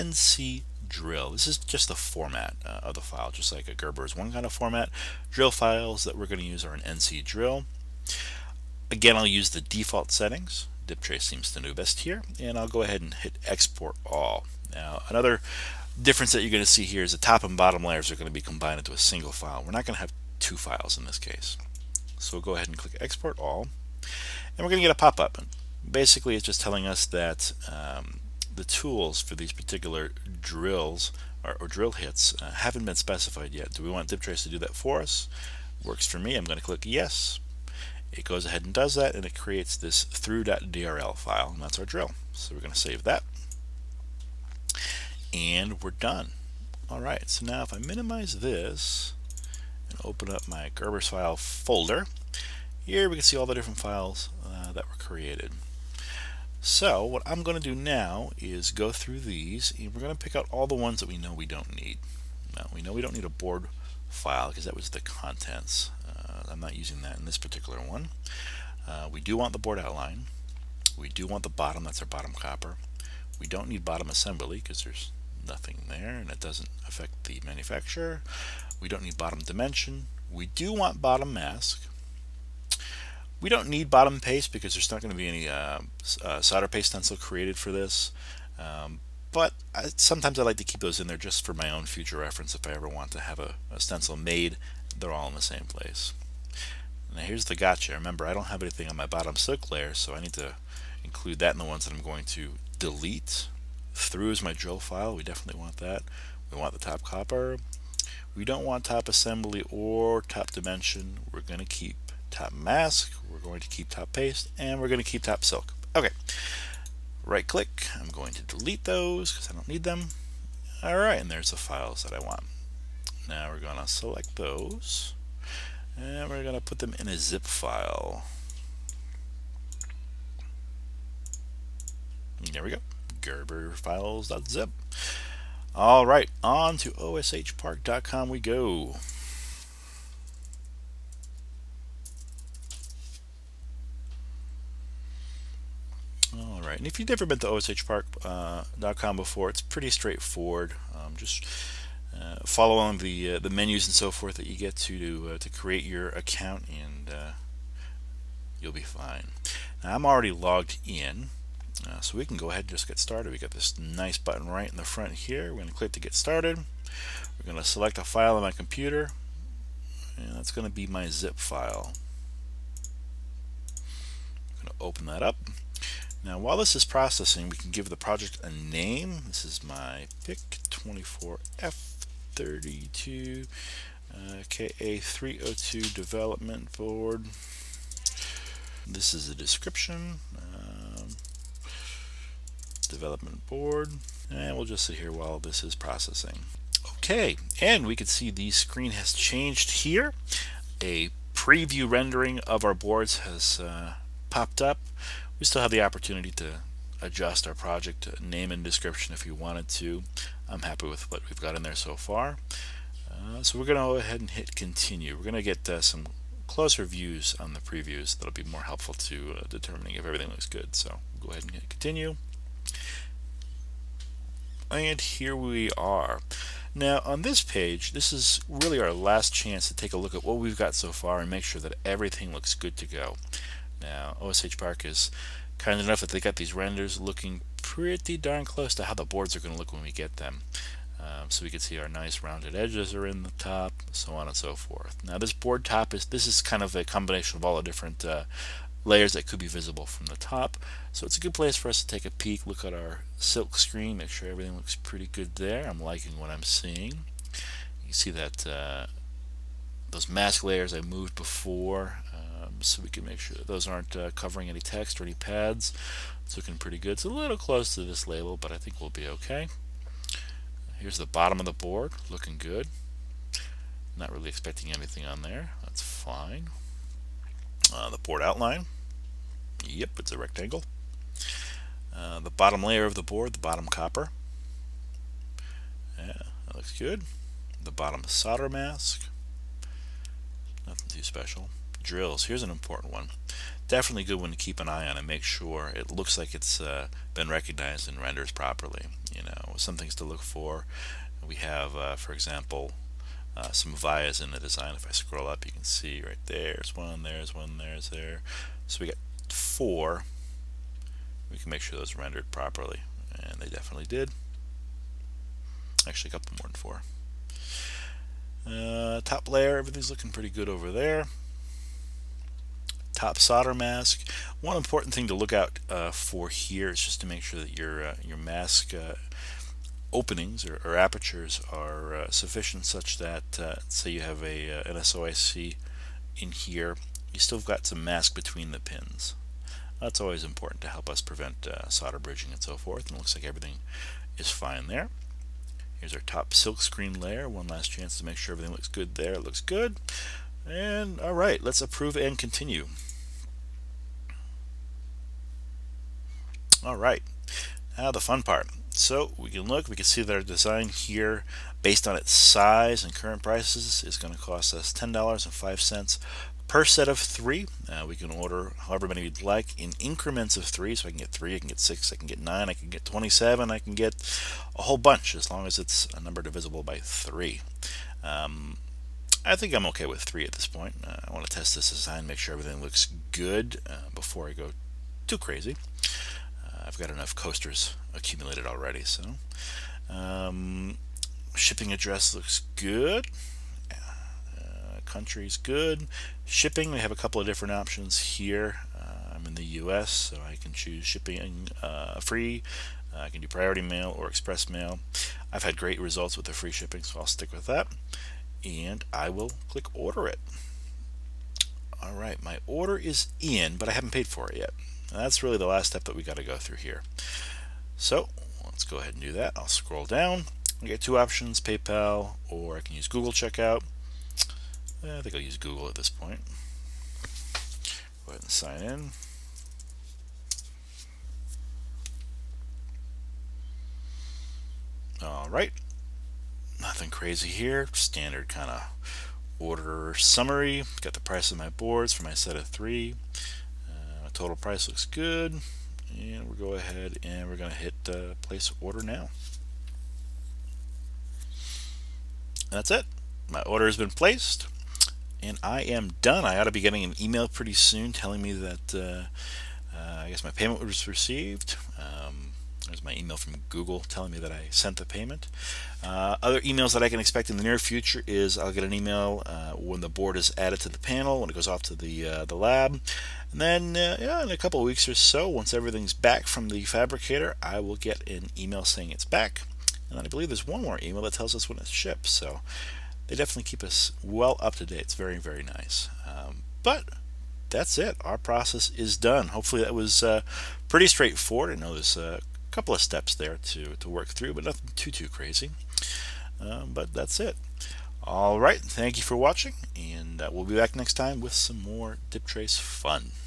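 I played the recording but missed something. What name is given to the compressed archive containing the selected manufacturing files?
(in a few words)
gerberfiles.zip.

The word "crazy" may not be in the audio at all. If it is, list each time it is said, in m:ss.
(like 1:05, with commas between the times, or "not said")
6:25, 7:16, 8:15.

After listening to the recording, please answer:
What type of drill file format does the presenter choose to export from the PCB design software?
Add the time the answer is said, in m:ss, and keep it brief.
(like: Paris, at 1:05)
NC drill, at 0:06.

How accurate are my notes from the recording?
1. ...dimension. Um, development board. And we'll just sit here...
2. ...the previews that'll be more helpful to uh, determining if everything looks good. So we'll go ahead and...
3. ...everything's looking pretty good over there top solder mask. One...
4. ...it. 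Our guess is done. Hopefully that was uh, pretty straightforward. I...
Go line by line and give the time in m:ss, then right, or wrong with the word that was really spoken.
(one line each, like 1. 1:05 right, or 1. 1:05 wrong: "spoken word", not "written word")
1. 3:09 wrong: "description", not "dimension"
2. 3:37 right
3. 5:19 right
4. 8:07 wrong: "process", not "guess".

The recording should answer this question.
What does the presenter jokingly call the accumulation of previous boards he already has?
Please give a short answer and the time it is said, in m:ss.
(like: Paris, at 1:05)
coasters, at 6:27.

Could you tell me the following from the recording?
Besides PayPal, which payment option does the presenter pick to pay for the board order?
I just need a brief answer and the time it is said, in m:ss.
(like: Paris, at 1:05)
Google Checkout, at 7:02.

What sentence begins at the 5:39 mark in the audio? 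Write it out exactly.
That's always important to help us prevent solder bridging and so forth.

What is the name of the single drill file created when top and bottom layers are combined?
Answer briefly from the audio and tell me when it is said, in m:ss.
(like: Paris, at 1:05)
through.drl, at 0:40.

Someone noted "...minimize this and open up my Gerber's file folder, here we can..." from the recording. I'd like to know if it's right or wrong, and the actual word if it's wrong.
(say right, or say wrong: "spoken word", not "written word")
right.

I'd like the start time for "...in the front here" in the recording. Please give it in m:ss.
2:44.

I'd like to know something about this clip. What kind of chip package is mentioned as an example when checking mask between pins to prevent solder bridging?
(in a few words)
SOIC.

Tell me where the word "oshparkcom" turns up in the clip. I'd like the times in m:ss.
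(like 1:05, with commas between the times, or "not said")
2:16, 2:27.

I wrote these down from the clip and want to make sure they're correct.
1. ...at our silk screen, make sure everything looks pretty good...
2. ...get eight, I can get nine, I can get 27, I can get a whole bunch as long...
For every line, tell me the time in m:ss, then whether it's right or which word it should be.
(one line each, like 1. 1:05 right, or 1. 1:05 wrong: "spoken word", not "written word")
1. 4:12 right
2. 6:11 wrong: "six", not "eight".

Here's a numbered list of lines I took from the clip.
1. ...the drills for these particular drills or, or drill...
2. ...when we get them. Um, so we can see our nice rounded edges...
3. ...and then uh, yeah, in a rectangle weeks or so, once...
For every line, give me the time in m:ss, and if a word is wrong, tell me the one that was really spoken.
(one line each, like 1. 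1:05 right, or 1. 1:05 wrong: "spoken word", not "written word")
1. 0:28 wrong: "tools", not "drills"
2. 3:59 right
3. 7:53 wrong: "couple", not "rectangle".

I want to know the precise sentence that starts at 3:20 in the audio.
A preview rendering of our boards has uh, popped up.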